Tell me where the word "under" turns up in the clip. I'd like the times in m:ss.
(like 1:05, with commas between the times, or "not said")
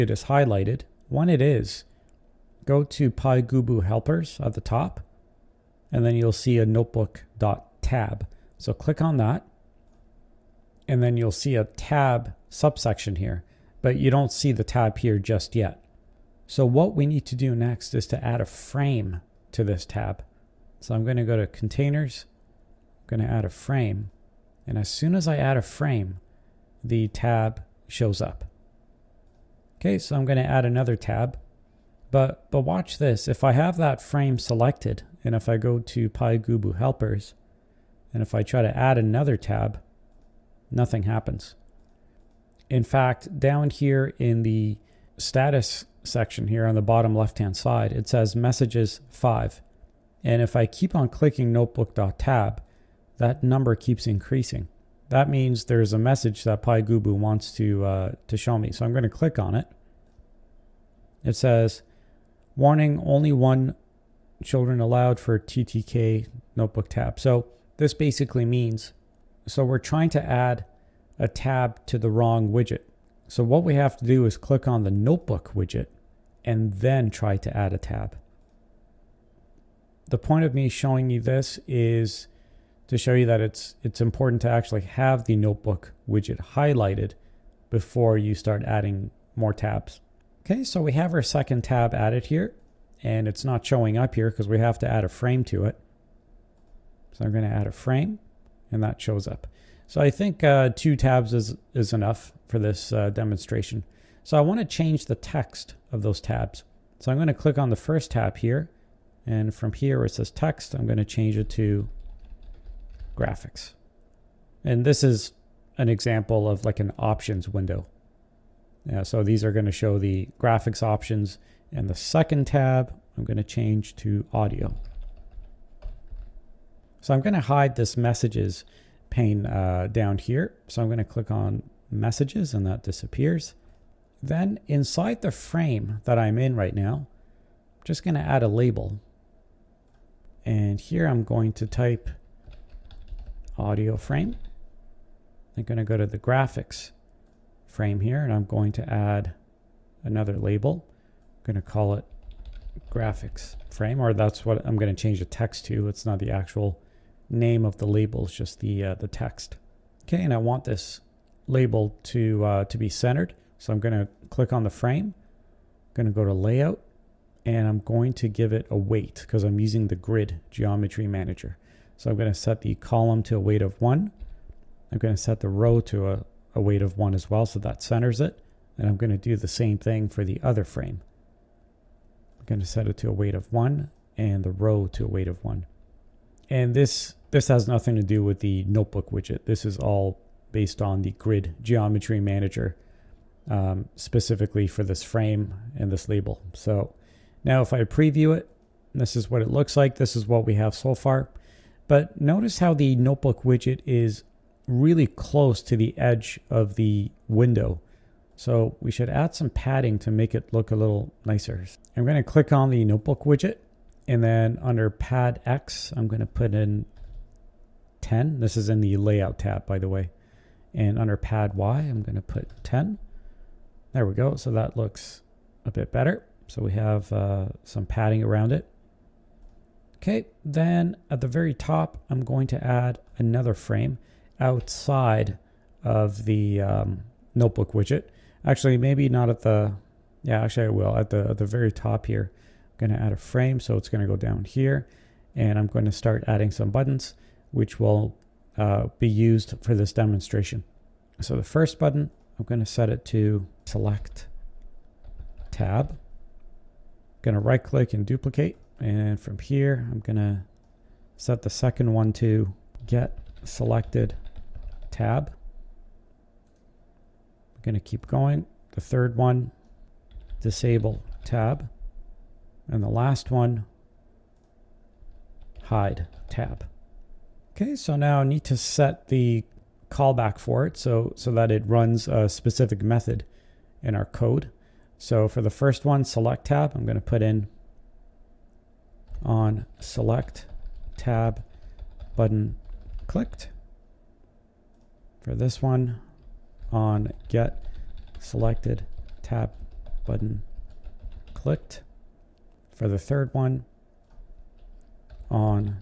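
3:34, 3:40.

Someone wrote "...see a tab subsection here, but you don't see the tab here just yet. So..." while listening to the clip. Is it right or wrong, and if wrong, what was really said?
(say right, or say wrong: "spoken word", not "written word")
right.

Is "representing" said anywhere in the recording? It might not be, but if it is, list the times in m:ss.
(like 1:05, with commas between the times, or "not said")
not said.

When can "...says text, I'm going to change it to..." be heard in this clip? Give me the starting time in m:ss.
1:50.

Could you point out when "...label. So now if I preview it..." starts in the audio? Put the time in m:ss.
3:16.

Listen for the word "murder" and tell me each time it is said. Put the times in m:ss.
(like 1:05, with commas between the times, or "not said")
not said.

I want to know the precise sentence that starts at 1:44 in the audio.
So I want to change the text of those tabs.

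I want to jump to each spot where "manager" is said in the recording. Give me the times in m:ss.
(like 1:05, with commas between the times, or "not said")
2:51, 3:12.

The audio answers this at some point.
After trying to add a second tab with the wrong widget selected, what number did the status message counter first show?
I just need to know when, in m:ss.
0:48.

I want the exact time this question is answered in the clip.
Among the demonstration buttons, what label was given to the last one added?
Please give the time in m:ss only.
4:35.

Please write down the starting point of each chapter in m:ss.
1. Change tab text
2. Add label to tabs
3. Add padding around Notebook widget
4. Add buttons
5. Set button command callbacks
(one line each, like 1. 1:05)
1. 1:44
2. 2:13
3. 3:22
4. 3:49
5. 4:37.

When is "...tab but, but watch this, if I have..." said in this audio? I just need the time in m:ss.
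0:30.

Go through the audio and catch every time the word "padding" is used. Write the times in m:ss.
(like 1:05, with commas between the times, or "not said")
3:29, 3:47.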